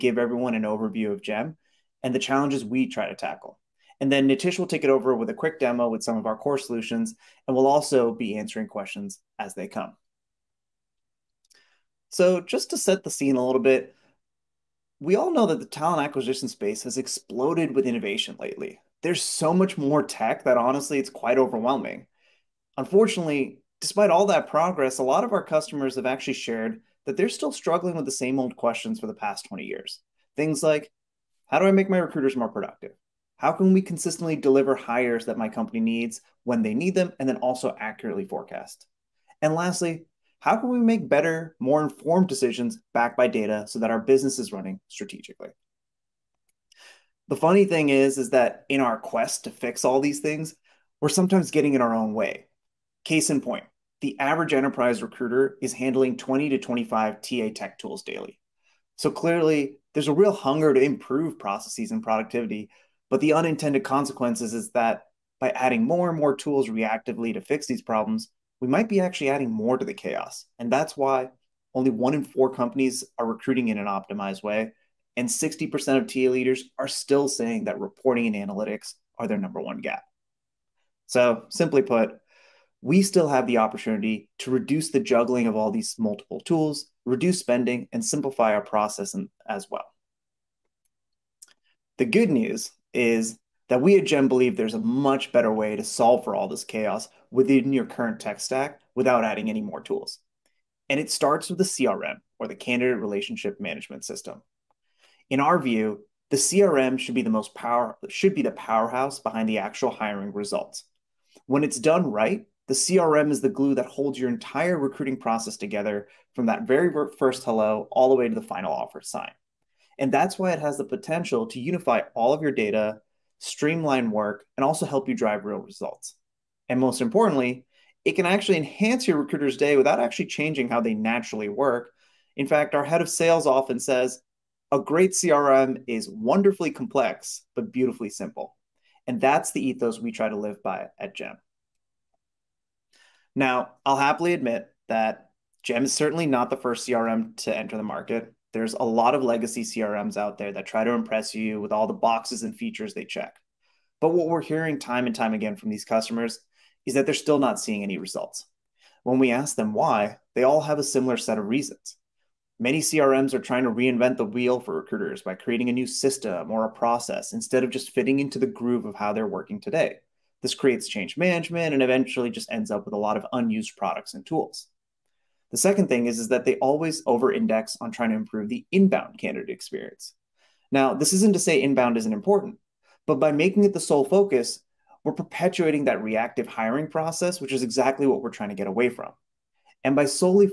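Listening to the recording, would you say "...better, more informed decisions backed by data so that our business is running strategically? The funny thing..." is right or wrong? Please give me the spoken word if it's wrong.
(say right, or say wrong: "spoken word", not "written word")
right.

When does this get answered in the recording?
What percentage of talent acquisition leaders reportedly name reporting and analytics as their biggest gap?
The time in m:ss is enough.
1:15.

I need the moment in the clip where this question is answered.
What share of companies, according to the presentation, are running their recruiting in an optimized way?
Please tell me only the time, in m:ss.
1:11.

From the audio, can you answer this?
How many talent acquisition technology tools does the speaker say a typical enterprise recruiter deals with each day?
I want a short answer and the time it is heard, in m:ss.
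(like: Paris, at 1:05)
20 to 25, at 0:56.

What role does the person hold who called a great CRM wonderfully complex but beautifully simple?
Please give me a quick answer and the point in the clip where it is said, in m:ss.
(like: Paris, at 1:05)
head of sales, at 2:12.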